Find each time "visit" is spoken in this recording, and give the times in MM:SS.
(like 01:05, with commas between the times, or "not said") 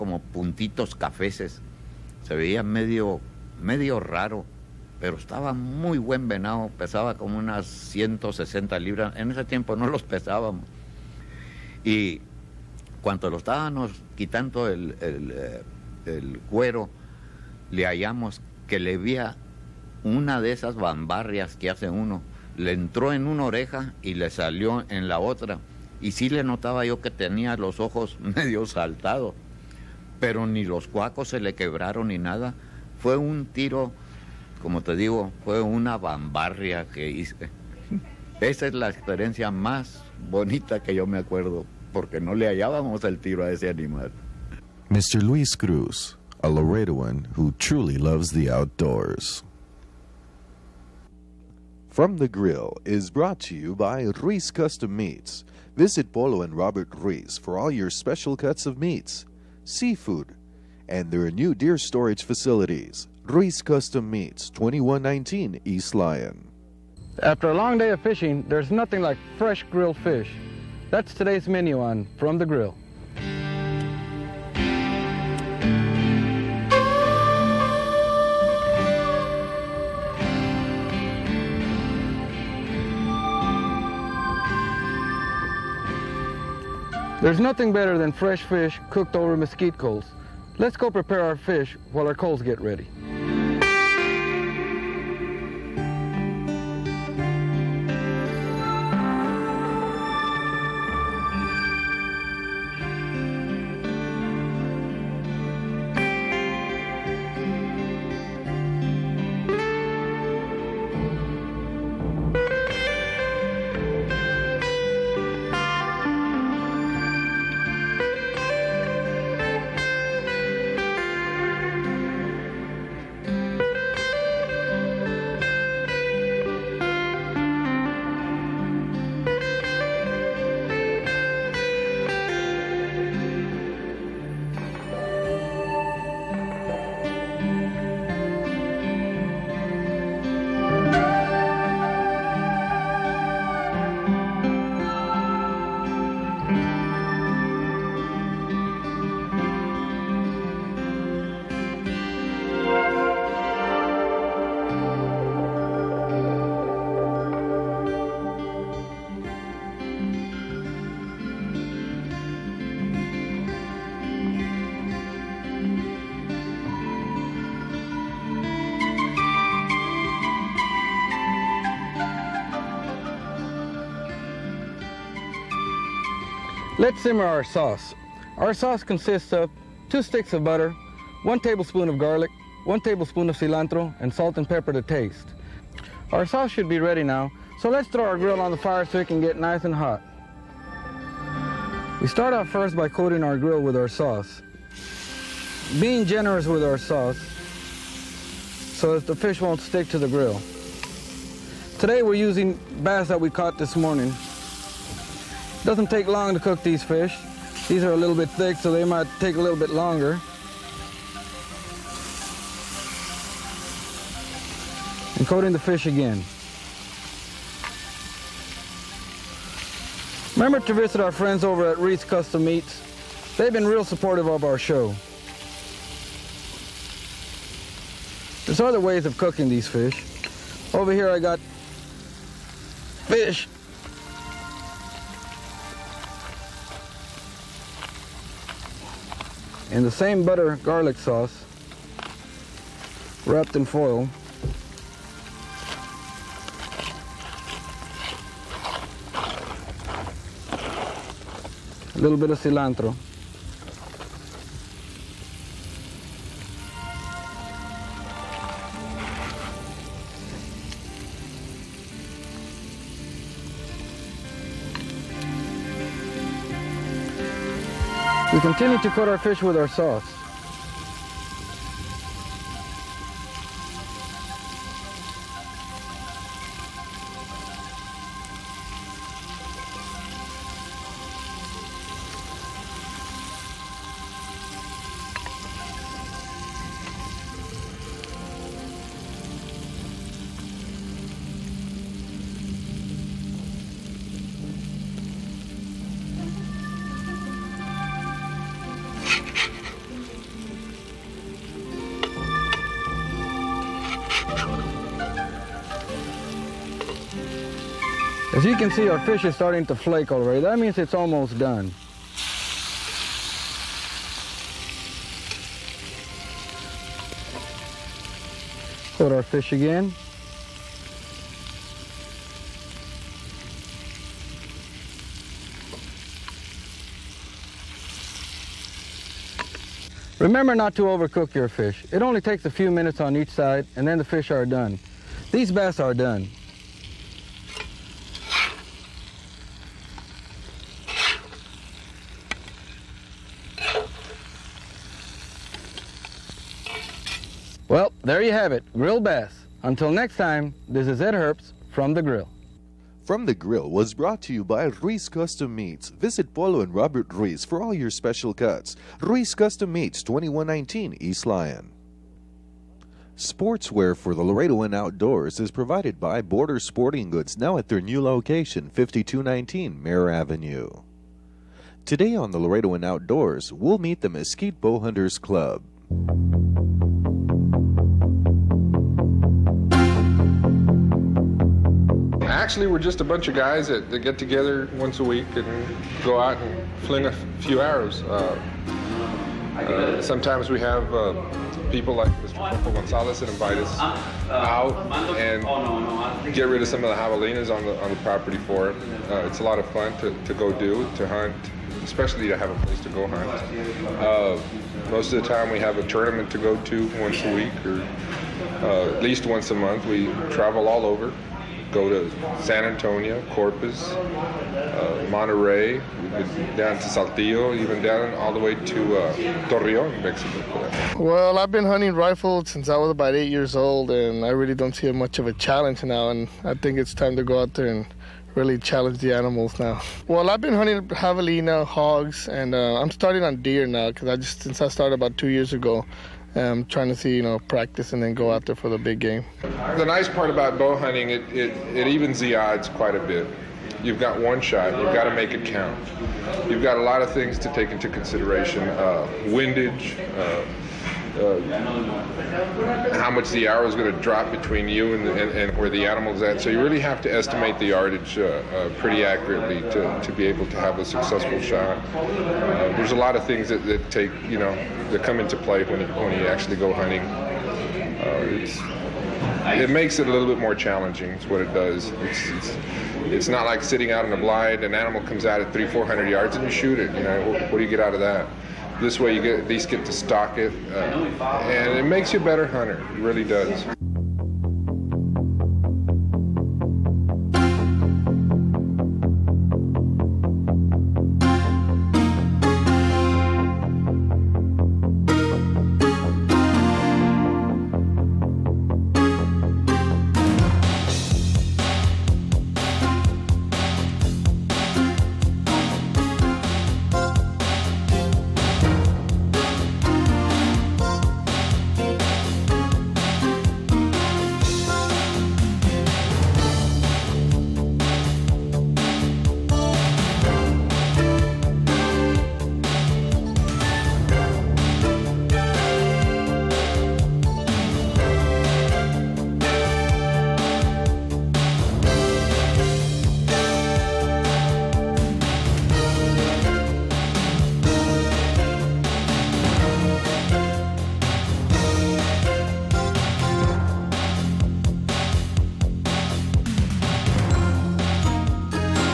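00:55, 03:40, 05:55.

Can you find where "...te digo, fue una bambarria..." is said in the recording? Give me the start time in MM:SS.
00:34.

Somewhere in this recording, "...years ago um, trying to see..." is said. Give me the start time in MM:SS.
07:15.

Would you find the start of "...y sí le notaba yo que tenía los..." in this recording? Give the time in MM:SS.
00:26.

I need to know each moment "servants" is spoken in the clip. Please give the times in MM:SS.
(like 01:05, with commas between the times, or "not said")
not said.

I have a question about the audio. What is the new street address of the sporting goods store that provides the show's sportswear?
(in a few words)
5219 Mare Avenue.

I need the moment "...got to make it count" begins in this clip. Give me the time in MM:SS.
07:24.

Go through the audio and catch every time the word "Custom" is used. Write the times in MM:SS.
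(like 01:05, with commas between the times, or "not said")
00:54, 01:03, 03:42, 05:55, 05:59.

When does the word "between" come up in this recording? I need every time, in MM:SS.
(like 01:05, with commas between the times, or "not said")
07:34.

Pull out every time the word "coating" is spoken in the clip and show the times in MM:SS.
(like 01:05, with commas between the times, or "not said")
03:12, 03:35.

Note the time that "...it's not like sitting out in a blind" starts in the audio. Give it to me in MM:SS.
07:53.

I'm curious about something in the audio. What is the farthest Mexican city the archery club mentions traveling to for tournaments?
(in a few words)
Torreon.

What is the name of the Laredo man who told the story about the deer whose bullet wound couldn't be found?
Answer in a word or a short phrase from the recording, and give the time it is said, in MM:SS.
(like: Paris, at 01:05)
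Luis Cruz, at 00:45.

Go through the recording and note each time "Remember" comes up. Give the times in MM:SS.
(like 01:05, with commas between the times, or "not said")
03:40, 05:30.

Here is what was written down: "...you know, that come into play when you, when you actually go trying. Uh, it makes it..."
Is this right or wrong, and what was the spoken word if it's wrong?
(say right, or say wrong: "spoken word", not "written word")
wrong: "hunting", not "trying".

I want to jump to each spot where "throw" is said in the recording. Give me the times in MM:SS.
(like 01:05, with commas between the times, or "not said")
03:07.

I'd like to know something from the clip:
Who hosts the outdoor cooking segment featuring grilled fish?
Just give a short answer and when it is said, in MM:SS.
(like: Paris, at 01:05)
Ed Herbst, at 05:50.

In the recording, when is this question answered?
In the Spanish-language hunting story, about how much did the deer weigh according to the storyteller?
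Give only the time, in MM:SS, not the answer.
00:07.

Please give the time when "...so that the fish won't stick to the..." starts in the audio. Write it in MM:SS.
03:18.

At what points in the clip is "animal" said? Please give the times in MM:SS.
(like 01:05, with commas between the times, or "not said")
00:43, 07:09, 07:35, 07:54.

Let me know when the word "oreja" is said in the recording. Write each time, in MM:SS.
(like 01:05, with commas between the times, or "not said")
00:23.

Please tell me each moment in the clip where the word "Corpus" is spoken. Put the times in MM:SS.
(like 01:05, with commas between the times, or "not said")
06:53.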